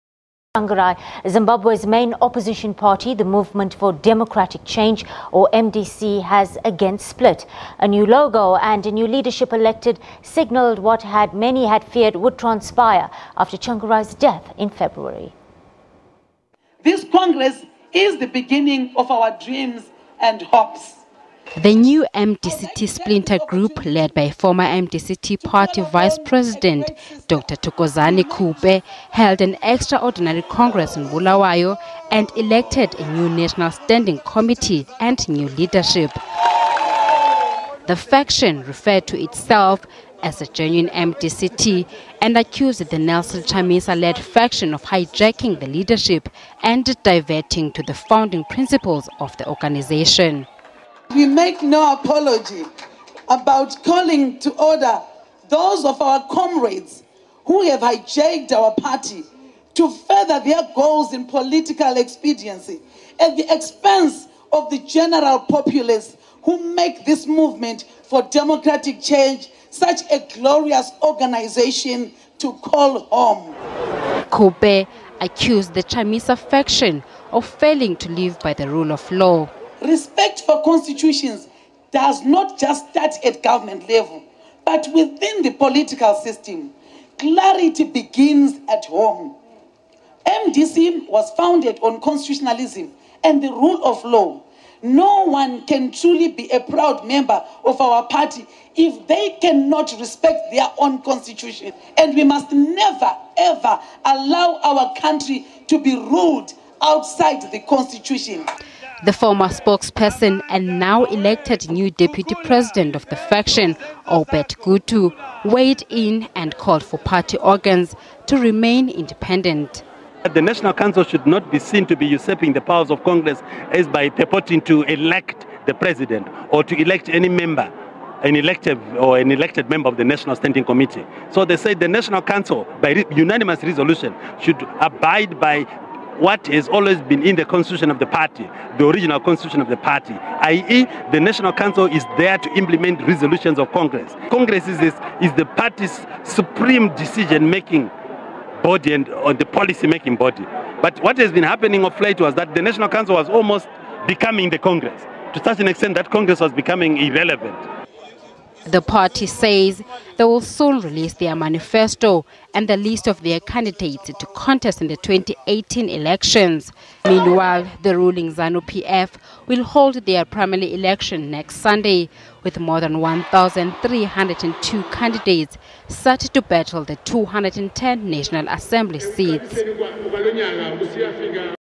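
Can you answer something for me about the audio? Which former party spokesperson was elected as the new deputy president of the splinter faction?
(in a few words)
Albert Gutu.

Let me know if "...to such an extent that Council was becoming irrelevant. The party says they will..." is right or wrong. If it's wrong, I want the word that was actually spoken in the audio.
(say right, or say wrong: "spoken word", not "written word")
wrong: "Congress", not "Council".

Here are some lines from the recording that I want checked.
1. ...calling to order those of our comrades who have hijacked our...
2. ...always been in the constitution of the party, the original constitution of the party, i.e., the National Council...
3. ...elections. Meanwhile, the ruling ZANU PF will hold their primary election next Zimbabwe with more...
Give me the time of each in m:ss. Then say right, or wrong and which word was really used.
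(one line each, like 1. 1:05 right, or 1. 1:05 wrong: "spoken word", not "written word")
1. 0:53 right
2. 2:16 right
3. 2:45 wrong: "Sunday", not "Zimbabwe".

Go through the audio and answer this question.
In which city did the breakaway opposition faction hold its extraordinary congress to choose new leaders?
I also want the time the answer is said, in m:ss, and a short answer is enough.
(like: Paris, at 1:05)
Bulawayo, at 0:31.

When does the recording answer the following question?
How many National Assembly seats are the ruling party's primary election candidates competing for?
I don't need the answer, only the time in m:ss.
2:56.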